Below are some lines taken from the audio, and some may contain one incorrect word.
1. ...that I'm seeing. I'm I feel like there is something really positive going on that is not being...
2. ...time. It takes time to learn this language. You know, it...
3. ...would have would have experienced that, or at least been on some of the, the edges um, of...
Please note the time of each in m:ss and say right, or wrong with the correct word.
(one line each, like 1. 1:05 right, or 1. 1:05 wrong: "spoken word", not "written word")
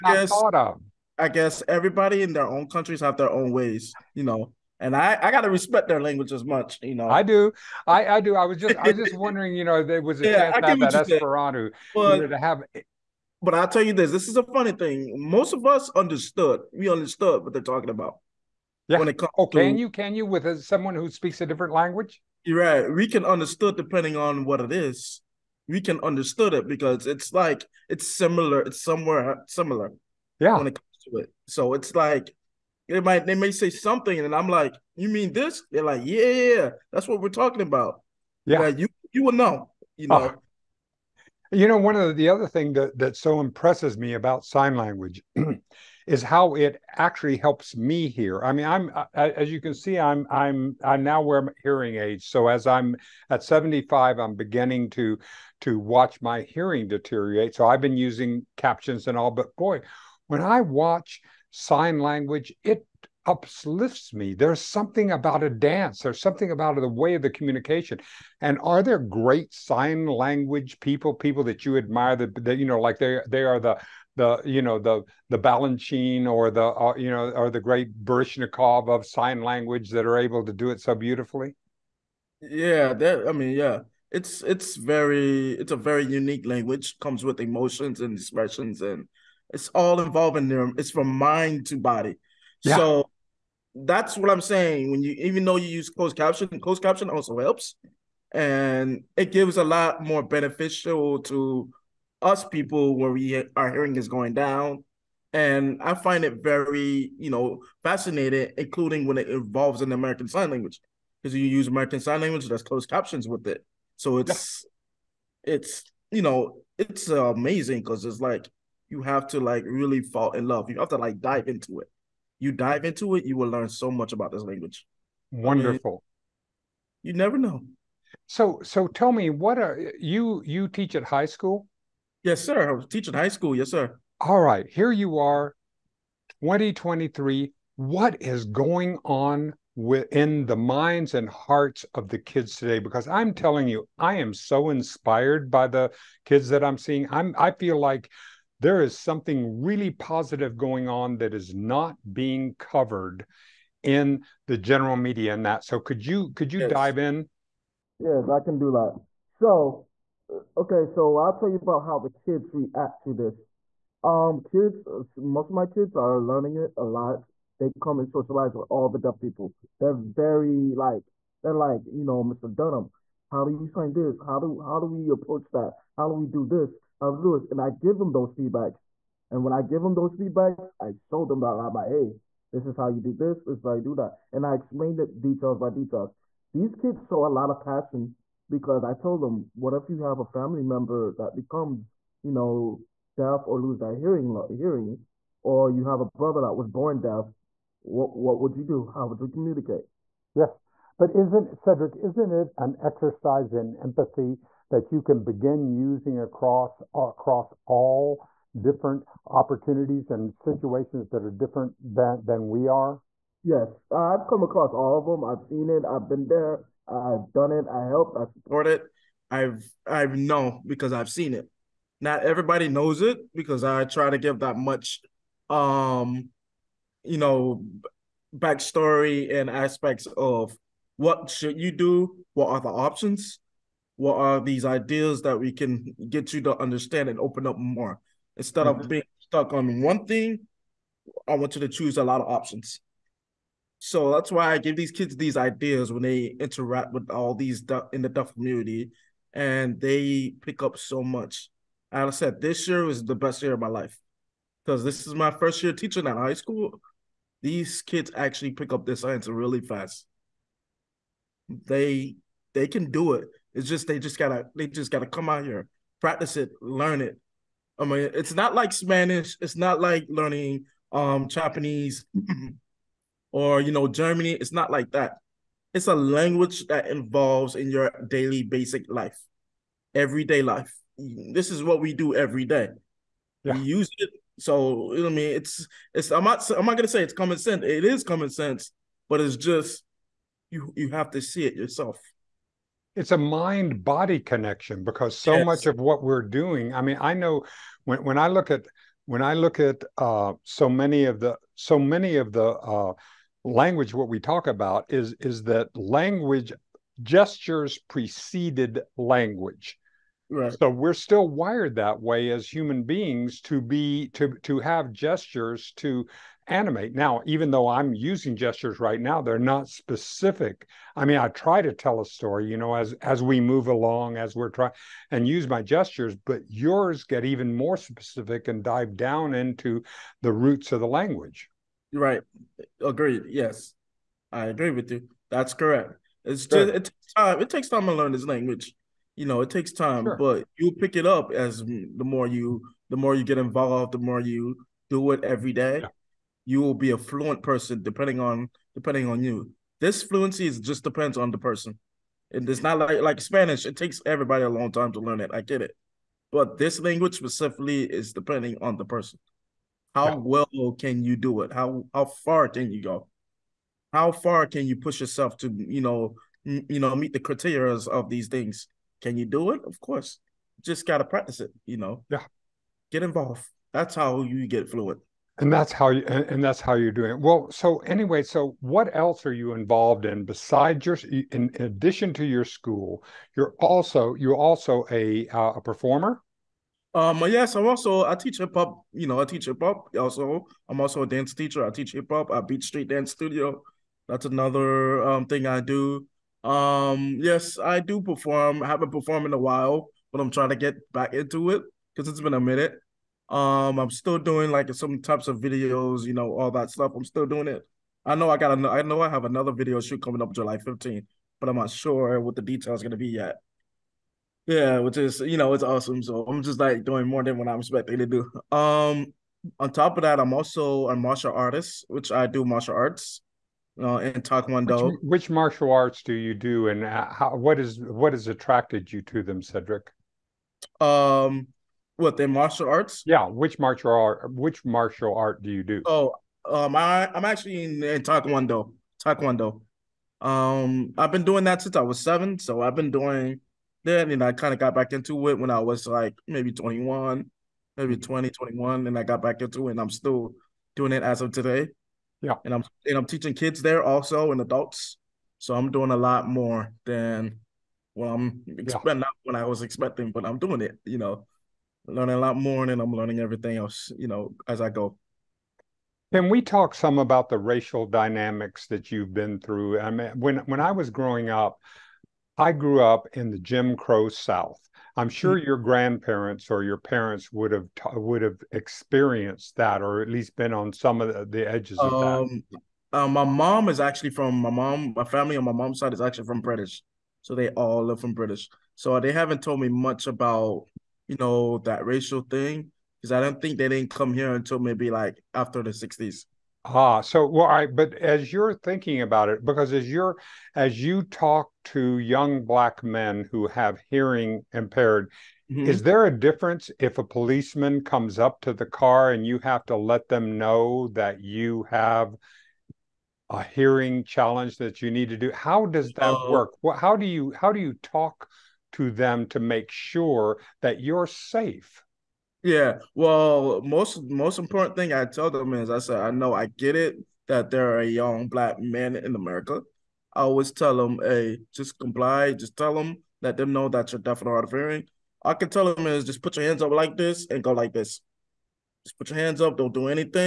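1. 2:26 right
2. 5:37 right
3. 7:57 right.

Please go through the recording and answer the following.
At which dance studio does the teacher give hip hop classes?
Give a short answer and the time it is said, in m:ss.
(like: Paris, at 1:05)
Beat Street Dance Studio, at 6:32.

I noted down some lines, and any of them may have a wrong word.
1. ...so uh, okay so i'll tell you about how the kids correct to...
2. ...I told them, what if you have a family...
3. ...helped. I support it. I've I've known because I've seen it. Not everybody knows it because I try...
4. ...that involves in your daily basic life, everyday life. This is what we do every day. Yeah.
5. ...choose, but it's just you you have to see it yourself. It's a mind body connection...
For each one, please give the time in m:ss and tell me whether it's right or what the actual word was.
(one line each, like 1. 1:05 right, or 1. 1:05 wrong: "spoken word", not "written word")
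1. 2:39 wrong: "react", not "correct"
2. 3:08 right
3. 3:37 right
4. 4:36 right
5. 4:48 wrong: "sense", not "choose".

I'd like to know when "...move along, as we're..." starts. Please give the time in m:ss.
5:23.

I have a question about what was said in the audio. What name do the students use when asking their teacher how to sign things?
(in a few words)
Mr. Dunham.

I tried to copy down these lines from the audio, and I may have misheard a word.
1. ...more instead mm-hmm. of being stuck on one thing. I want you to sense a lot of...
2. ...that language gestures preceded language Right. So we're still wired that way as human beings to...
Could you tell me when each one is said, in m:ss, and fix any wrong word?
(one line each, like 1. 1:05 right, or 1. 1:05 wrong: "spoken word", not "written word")
1. 3:57 wrong: "choose", not "sense"
2. 5:05 right.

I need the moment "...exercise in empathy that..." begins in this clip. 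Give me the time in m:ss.
3:22.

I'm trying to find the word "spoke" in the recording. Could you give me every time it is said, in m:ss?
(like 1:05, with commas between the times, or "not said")
not said.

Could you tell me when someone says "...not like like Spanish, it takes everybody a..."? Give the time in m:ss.
5:52.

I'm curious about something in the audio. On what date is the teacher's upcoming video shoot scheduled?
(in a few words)
July 15th.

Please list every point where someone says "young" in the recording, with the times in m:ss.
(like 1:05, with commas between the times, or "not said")
8:21, 8:47.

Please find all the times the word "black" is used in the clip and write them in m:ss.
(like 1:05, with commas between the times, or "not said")
8:22, 8:48.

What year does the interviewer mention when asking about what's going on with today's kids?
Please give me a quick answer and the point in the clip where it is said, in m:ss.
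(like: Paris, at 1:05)
2023, at 2:16.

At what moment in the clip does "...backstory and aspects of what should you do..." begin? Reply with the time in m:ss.
3:48.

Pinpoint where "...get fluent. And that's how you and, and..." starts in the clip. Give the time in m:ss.
6:14.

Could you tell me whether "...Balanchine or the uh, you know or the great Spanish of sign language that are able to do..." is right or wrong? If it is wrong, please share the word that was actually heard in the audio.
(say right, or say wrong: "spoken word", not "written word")
wrong: "Baryshnikov", not "Spanish".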